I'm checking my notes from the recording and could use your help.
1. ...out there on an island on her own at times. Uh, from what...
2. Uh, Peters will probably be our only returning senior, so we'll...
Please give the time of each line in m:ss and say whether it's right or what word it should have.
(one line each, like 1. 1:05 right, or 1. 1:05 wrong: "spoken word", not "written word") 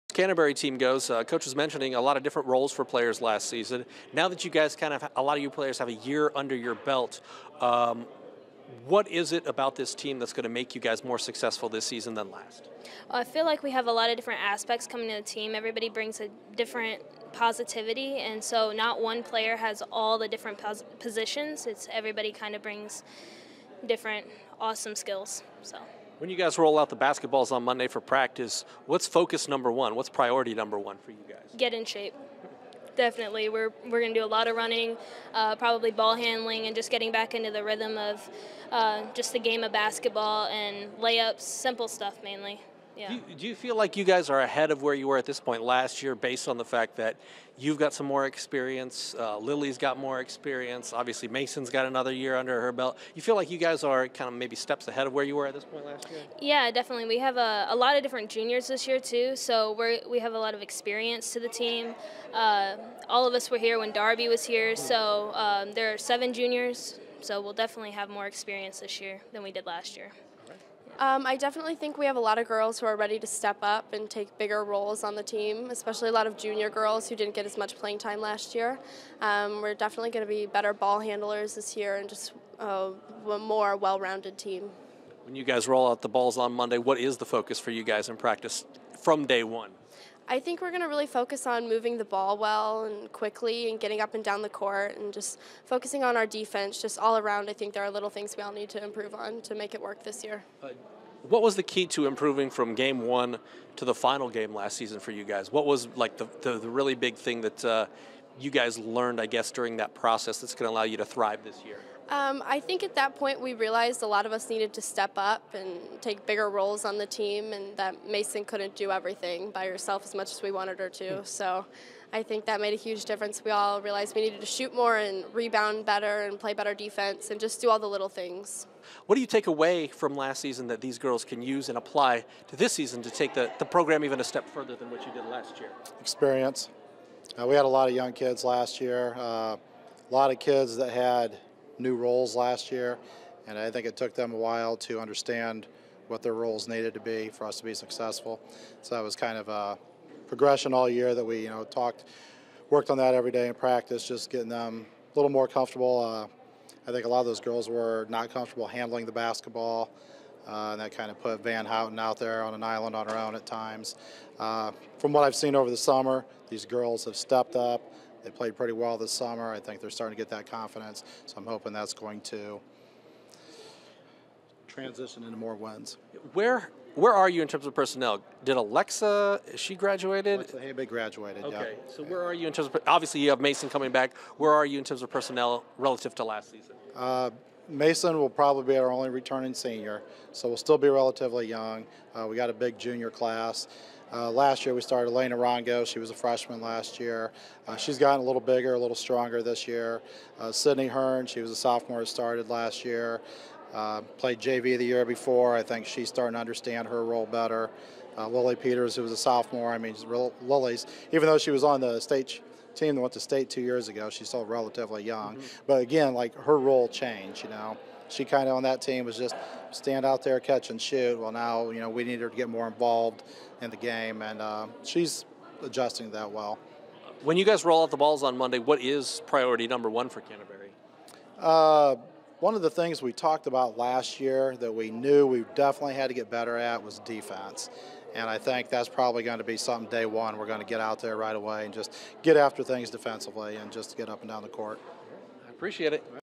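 1. 2:41 right
2. 3:06 wrong: "Mason", not "Peters".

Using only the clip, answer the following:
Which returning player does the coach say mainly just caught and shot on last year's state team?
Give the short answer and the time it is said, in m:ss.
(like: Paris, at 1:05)
Lilly Peters, at 3:28.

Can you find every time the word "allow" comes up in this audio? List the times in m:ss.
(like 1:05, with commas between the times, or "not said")
1:50.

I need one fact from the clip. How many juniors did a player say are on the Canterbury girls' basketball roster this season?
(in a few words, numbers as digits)
7.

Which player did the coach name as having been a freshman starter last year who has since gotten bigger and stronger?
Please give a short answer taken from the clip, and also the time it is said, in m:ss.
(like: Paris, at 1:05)
Elena Rongo, at 3:15.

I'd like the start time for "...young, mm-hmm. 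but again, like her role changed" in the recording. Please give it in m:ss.
3:35.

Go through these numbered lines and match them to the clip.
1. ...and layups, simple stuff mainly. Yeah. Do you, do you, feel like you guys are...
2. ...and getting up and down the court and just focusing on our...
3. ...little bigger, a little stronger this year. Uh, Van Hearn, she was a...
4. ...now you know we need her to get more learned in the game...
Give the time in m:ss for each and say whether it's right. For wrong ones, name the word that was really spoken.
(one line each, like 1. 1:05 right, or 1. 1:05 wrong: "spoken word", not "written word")
1. 0:40 right
2. 1:33 right
3. 3:18 wrong: "Sydney", not "Van"
4. 3:41 wrong: "involved", not "learned".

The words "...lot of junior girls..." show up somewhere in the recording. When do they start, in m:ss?
1:16.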